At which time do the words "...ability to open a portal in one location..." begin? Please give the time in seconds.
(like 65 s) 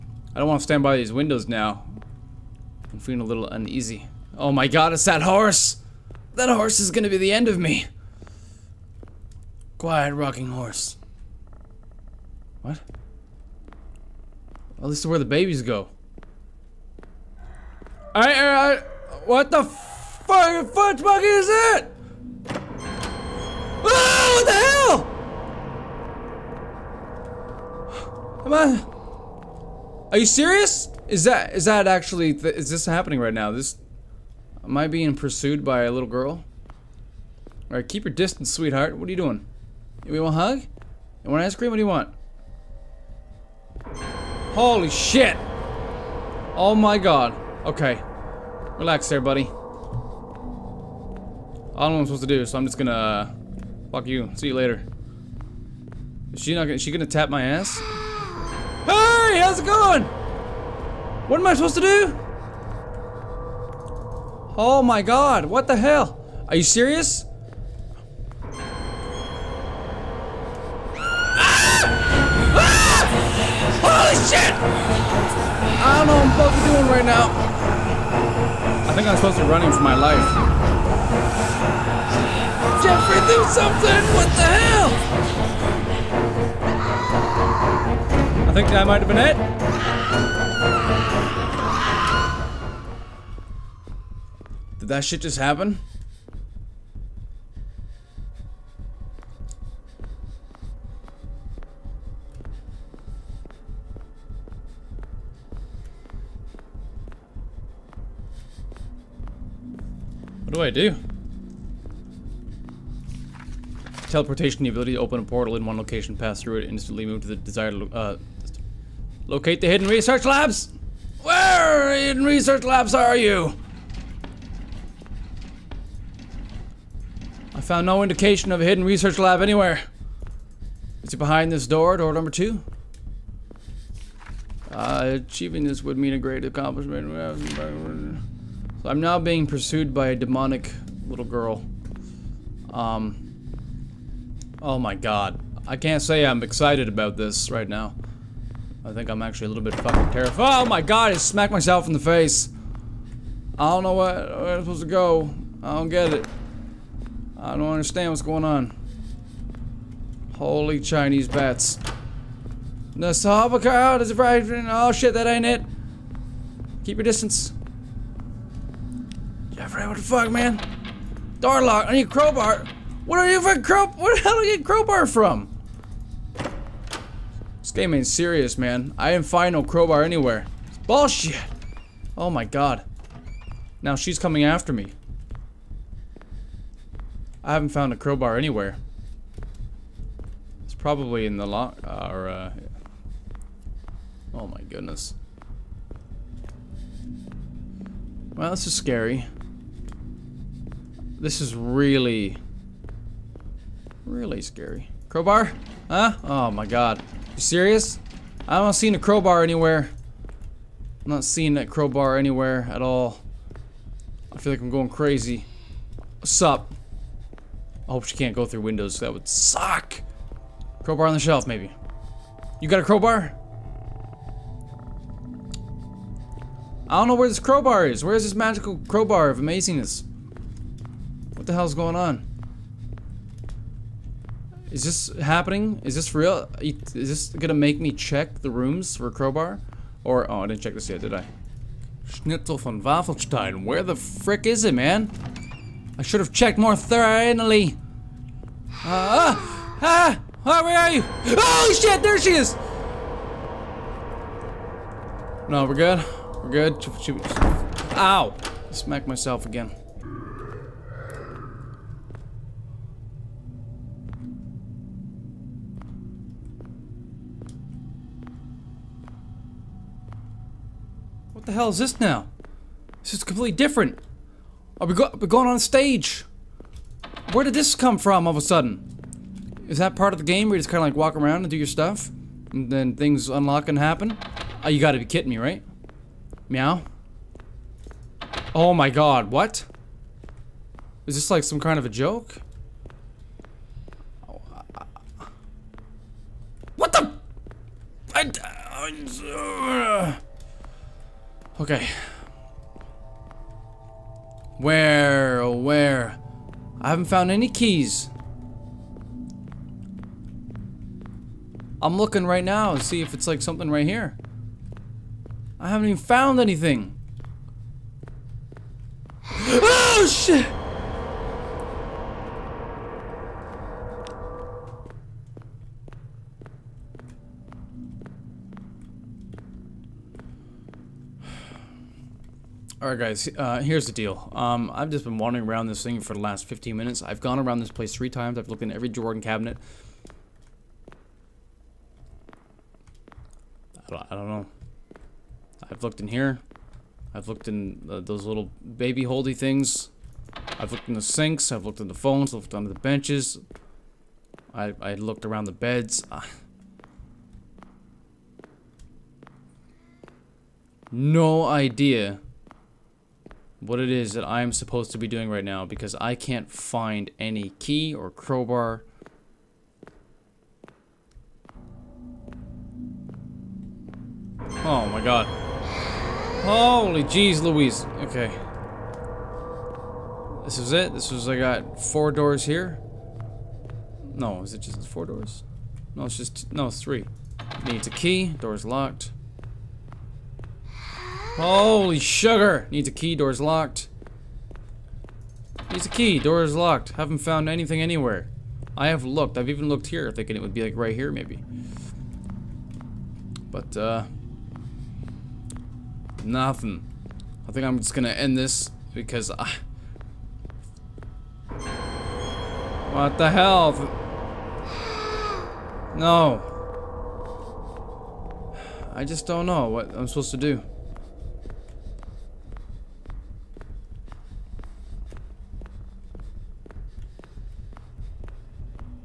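114 s.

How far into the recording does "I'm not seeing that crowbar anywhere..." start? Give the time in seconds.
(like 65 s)
211 s.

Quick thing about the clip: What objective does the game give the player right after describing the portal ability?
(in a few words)
Locate the hidden research labs.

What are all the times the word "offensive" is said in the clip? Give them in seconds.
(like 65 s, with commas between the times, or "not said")
not said.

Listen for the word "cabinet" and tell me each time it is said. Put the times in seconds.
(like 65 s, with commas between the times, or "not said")
339 s.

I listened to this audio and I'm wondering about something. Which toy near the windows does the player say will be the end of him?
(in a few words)
rocking horse.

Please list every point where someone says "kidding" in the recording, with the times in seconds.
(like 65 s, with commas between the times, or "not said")
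285 s.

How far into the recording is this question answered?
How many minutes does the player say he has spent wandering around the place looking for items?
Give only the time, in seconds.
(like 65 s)
336 s.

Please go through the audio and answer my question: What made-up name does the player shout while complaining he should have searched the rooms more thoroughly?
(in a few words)
Schnitzel von Waffelstein.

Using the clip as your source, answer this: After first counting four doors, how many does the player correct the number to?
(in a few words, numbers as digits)
3.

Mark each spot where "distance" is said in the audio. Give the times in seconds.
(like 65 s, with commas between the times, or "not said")
38 s, 167 s.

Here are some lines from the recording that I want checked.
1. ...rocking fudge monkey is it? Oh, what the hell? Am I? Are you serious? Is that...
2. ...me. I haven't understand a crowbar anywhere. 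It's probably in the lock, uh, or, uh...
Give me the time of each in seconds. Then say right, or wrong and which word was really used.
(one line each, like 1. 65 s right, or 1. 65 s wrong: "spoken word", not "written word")
1. 20 s wrong: "fucking", not "rocking"
2. 184 s wrong: "found", not "understand".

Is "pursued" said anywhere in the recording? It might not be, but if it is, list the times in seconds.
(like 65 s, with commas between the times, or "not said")
35 s, 139 s.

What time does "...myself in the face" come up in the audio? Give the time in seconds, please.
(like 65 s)
151 s.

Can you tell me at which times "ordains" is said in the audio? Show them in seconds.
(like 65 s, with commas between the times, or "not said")
not said.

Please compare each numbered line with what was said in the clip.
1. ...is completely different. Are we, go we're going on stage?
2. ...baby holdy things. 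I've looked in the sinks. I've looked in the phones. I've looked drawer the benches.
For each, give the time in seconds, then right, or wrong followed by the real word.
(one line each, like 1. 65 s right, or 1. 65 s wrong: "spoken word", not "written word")
1. 273 s right
2. 348 s wrong: "under", not "drawer".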